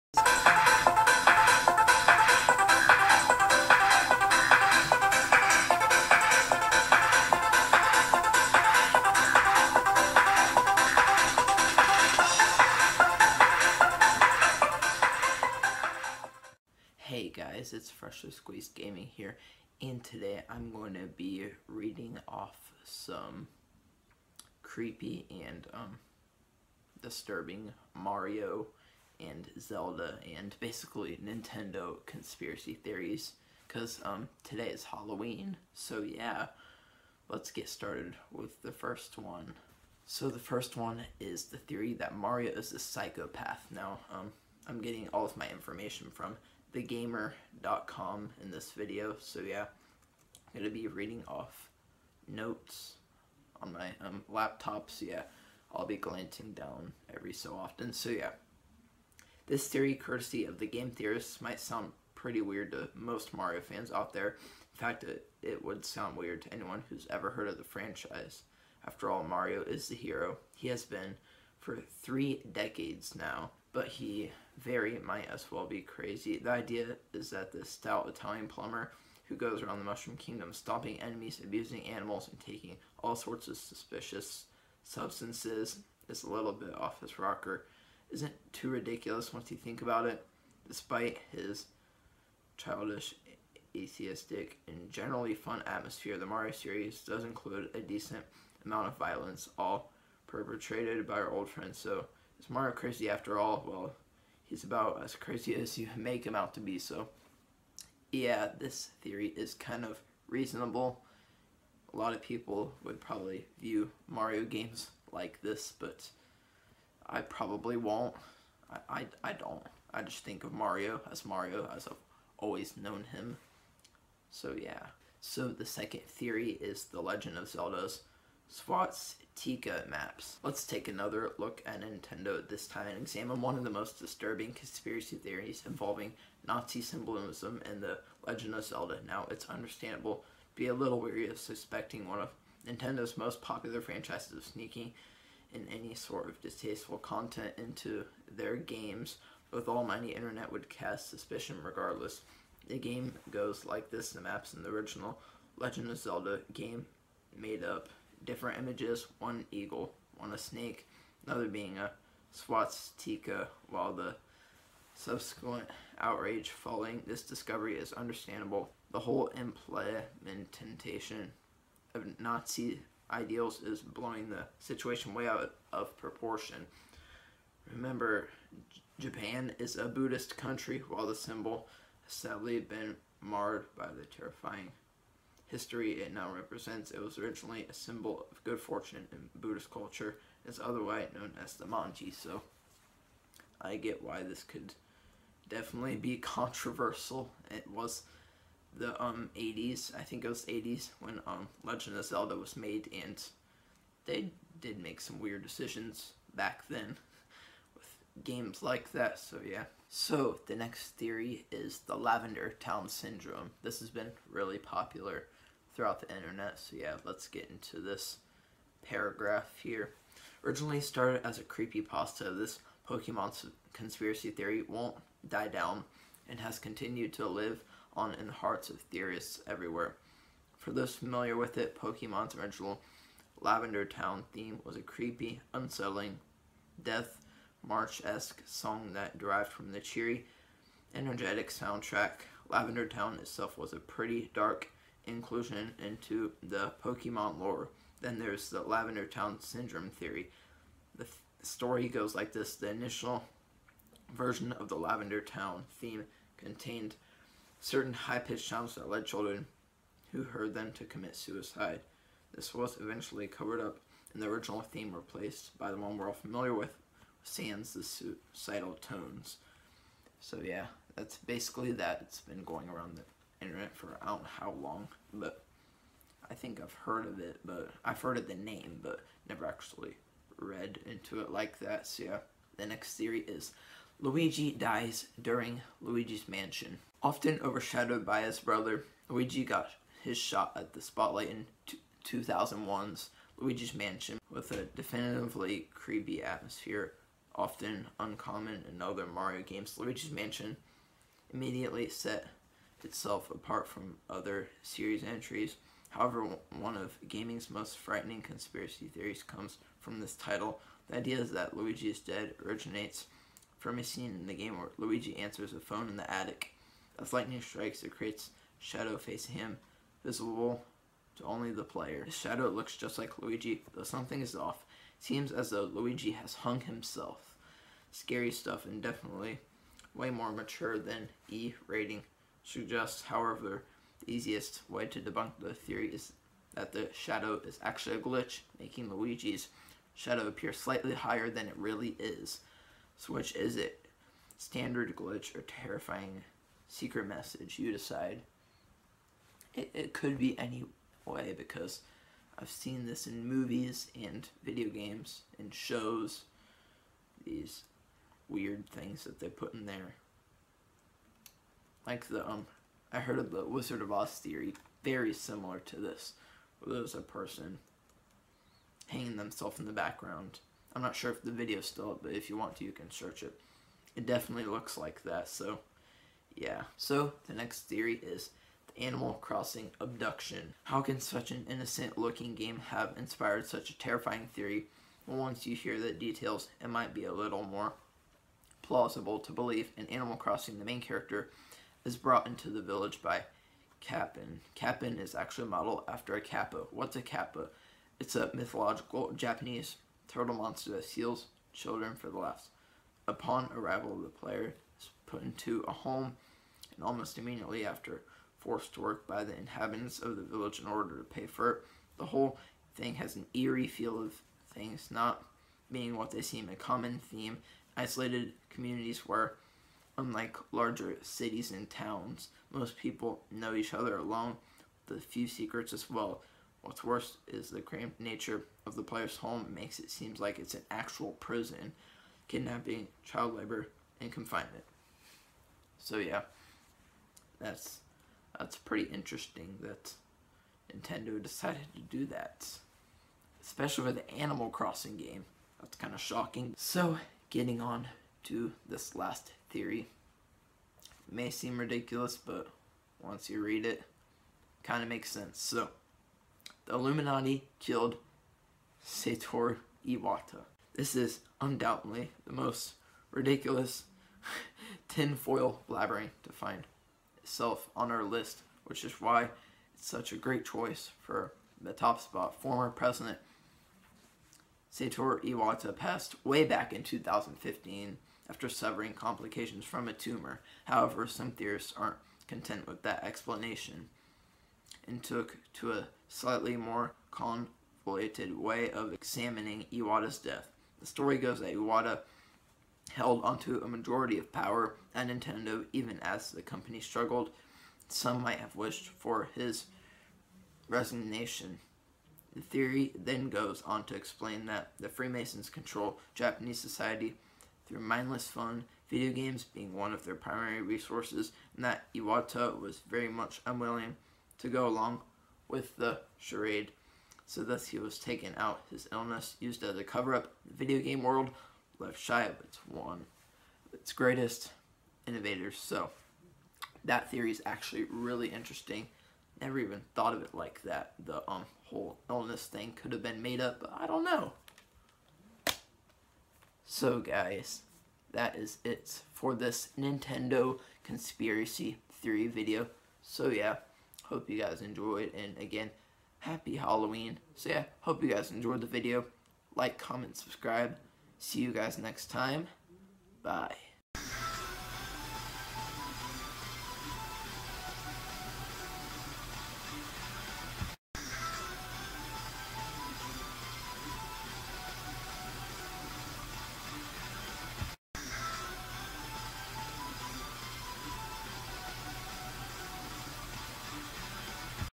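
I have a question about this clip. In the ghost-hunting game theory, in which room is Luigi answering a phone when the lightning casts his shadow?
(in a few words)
attic.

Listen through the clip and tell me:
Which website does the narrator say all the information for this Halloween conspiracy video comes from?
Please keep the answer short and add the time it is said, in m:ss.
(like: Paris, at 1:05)
thegamer.com, at 0:46.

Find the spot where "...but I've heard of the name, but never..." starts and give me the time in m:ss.
4:37.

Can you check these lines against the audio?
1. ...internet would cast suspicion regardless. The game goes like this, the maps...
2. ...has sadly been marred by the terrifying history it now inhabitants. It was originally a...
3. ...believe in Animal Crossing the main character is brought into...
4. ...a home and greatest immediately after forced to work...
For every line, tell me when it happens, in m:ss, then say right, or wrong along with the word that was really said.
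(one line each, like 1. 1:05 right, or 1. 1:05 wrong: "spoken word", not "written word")
1. 2:30 right
2. 3:02 wrong: "represents", not "inhabitants"
3. 6:29 right
4. 6:45 wrong: "almost", not "greatest".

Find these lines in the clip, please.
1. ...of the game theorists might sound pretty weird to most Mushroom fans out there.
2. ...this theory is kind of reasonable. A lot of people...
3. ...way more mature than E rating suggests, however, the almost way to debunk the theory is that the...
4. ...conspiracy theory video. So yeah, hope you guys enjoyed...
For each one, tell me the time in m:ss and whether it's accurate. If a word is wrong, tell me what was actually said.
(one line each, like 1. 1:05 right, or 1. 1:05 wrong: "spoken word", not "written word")
1. 1:00 wrong: "Mario", not "Mushroom"
2. 1:48 right
3. 5:29 wrong: "easiest", not "almost"
4. 9:00 right.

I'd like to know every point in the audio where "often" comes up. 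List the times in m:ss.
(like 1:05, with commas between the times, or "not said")
0:57, 4:47, 4:57.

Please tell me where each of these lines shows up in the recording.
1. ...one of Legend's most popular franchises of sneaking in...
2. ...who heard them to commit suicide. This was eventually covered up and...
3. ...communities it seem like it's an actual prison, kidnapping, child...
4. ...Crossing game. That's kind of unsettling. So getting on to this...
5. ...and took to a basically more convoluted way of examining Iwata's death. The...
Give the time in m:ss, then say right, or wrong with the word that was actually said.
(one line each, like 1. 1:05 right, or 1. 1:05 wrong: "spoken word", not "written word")
1. 2:22 wrong: "Nintendo", not "Legend"
2. 4:20 right
3. 7:09 wrong: "makes", not "communities"
4. 7:24 wrong: "shocking", not "unsettling"
5. 8:04 wrong: "slightly", not "basically".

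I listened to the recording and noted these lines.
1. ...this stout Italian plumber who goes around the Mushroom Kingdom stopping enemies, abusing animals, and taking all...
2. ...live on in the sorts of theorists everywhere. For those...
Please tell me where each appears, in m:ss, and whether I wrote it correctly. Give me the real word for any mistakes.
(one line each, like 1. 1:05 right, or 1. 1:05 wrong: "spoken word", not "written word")
1. 1:17 right
2. 3:47 wrong: "hearts", not "sorts".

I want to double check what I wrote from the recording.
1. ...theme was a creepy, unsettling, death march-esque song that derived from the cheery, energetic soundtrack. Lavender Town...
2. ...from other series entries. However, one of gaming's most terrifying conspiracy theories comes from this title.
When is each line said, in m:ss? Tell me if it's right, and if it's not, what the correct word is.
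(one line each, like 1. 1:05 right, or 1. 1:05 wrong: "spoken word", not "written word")
1. 3:54 right
2. 5:03 wrong: "frightening", not "terrifying".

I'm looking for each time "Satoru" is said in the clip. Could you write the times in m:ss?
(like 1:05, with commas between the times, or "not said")
7:38, 7:54.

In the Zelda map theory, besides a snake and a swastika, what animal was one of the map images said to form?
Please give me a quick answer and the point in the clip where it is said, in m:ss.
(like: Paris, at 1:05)
eagle, at 2:39.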